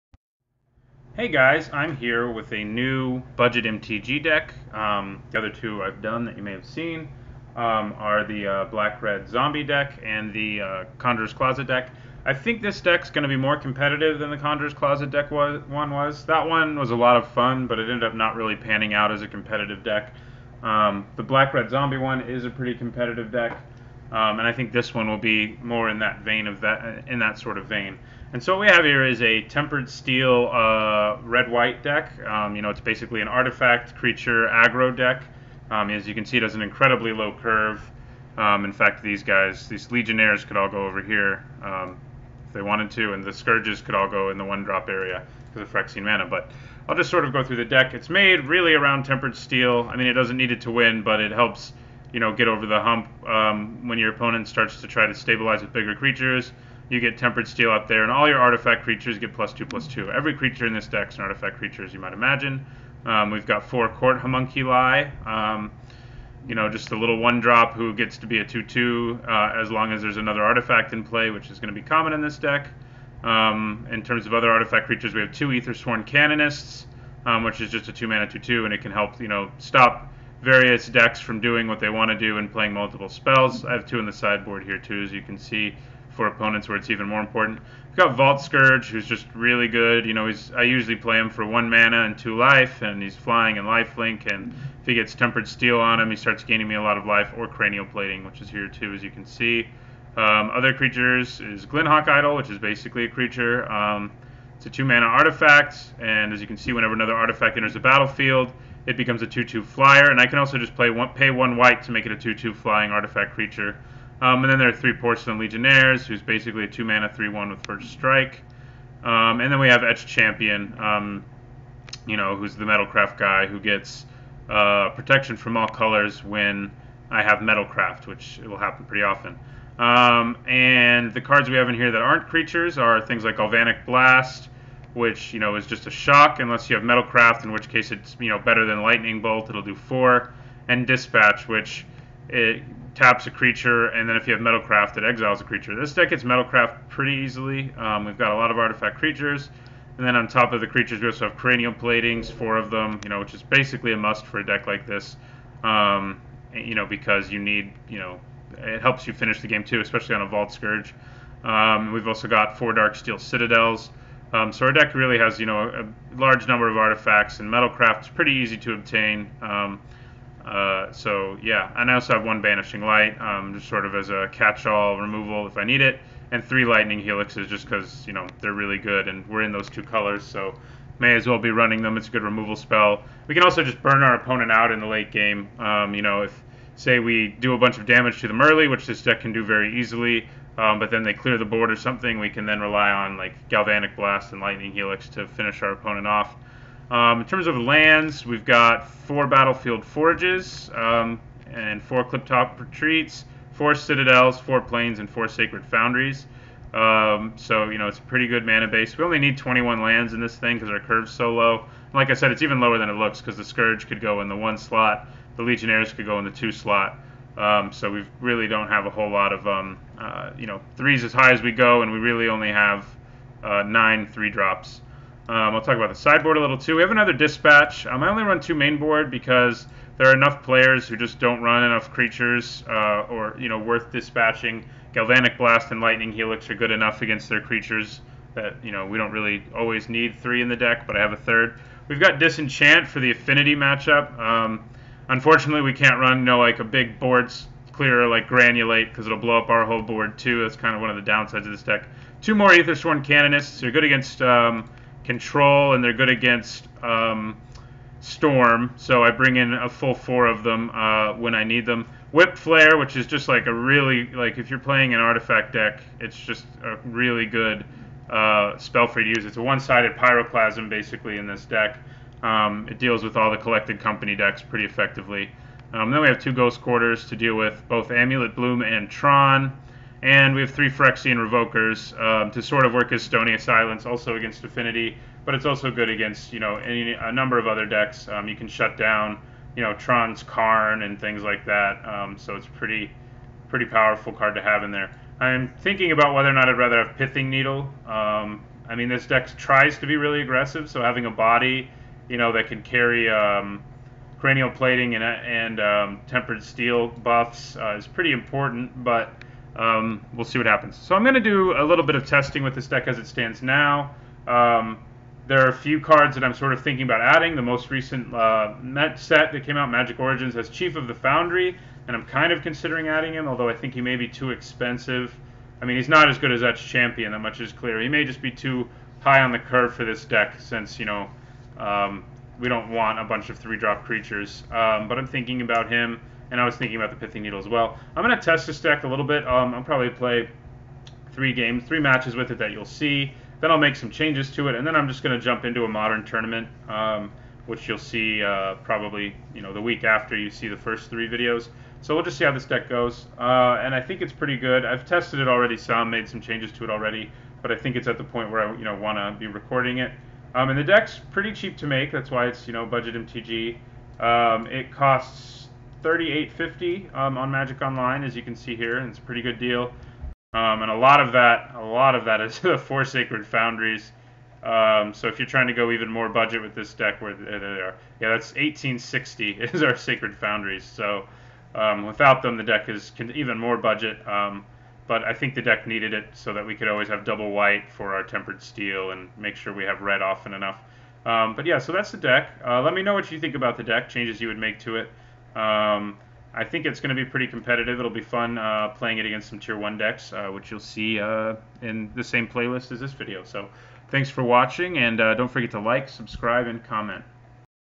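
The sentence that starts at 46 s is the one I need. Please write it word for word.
But I'll just sort of go through the deck.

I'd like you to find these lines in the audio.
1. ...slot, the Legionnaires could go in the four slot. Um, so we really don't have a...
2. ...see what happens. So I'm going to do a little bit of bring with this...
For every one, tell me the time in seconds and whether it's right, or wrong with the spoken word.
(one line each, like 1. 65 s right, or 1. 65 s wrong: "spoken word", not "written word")
1. 214 s wrong: "two", not "four"
2. 310 s wrong: "testing", not "bring".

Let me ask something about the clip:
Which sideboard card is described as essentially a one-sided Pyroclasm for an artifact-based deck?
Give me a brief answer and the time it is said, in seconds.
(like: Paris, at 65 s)
Whipflare, at 262 s.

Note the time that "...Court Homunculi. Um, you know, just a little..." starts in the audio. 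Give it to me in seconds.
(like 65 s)
63 s.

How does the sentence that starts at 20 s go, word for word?
Um, the Black Red Zombie one is a pretty competitive deck.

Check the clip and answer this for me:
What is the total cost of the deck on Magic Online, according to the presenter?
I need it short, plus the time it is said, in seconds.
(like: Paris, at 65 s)
$38.50, at 365 s.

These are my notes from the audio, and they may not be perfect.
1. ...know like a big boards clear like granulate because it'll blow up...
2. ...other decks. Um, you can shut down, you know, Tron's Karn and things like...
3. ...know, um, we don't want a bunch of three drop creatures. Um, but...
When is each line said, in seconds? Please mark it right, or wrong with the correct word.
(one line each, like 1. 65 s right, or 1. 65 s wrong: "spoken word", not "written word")
1. 246 s right
2. 287 s right
3. 330 s right.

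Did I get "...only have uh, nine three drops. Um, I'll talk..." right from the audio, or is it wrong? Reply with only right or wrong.
right.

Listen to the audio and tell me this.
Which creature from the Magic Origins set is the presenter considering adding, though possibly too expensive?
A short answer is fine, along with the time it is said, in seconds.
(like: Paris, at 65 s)
Chief of the Foundry, at 320 s.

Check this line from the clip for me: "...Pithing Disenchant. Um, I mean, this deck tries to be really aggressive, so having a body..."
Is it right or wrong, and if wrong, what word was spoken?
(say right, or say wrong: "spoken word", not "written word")
wrong: "Needle", not "Disenchant".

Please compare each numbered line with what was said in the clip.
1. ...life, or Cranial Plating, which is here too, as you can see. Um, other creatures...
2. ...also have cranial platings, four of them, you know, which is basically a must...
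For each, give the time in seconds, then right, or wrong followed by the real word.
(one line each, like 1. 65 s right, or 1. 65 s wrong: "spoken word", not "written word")
1. 97 s right
2. 151 s right.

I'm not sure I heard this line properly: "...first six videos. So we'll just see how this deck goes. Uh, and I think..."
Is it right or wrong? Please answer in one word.
wrong.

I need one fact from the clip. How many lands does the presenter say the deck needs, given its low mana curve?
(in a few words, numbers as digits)
21.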